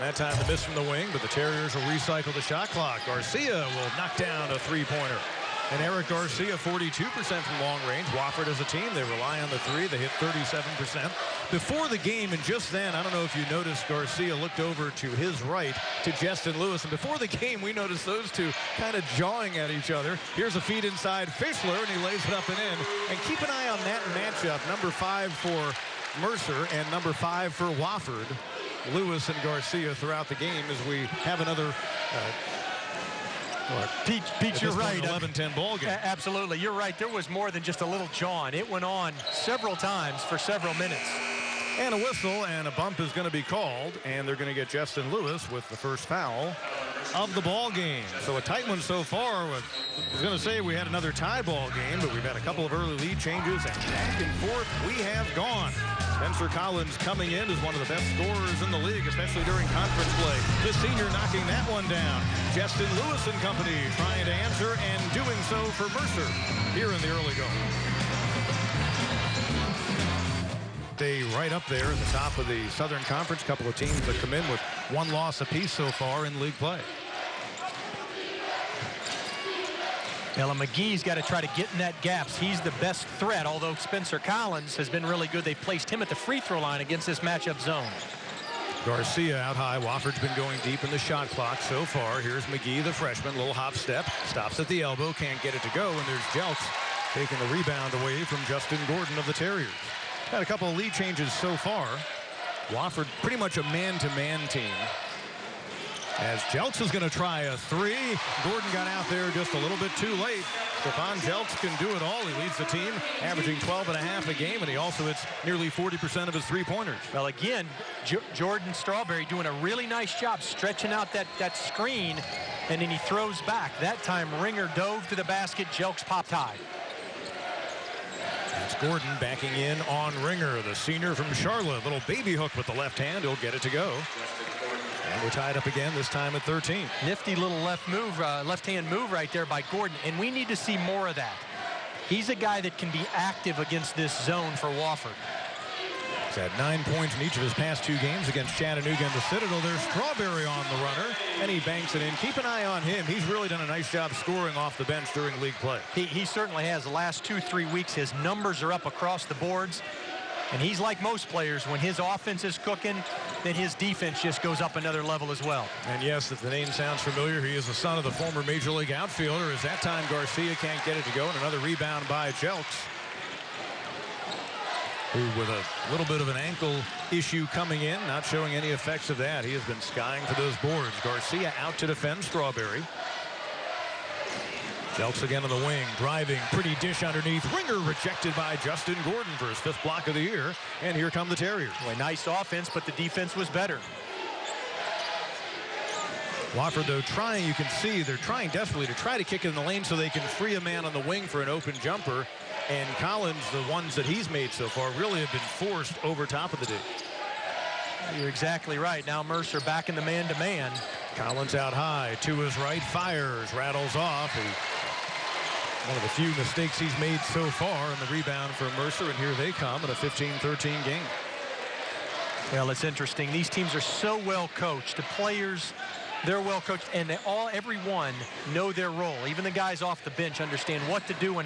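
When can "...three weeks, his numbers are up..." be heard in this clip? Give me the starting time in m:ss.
2:37.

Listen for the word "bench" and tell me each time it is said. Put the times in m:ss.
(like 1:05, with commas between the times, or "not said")
2:34, 3:50.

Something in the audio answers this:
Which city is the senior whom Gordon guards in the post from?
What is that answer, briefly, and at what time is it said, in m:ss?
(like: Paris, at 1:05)
Charlotte, at 2:11.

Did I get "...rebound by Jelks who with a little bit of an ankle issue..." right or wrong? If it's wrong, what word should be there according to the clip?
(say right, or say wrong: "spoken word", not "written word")
right.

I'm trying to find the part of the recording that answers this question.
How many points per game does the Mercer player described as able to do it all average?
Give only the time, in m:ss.
1:53.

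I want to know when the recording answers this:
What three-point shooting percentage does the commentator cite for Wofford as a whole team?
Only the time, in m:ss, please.
0:10.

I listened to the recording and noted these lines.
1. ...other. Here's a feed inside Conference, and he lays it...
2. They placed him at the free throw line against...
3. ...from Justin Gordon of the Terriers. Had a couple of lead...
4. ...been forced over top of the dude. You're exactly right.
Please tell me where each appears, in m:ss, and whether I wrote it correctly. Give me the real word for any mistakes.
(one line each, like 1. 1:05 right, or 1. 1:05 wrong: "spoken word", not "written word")
1. 0:19 wrong: "Fischler", not "Conference"
2. 1:25 right
3. 1:38 right
4. 3:25 right.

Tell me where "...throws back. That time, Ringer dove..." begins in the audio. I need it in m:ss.
2:02.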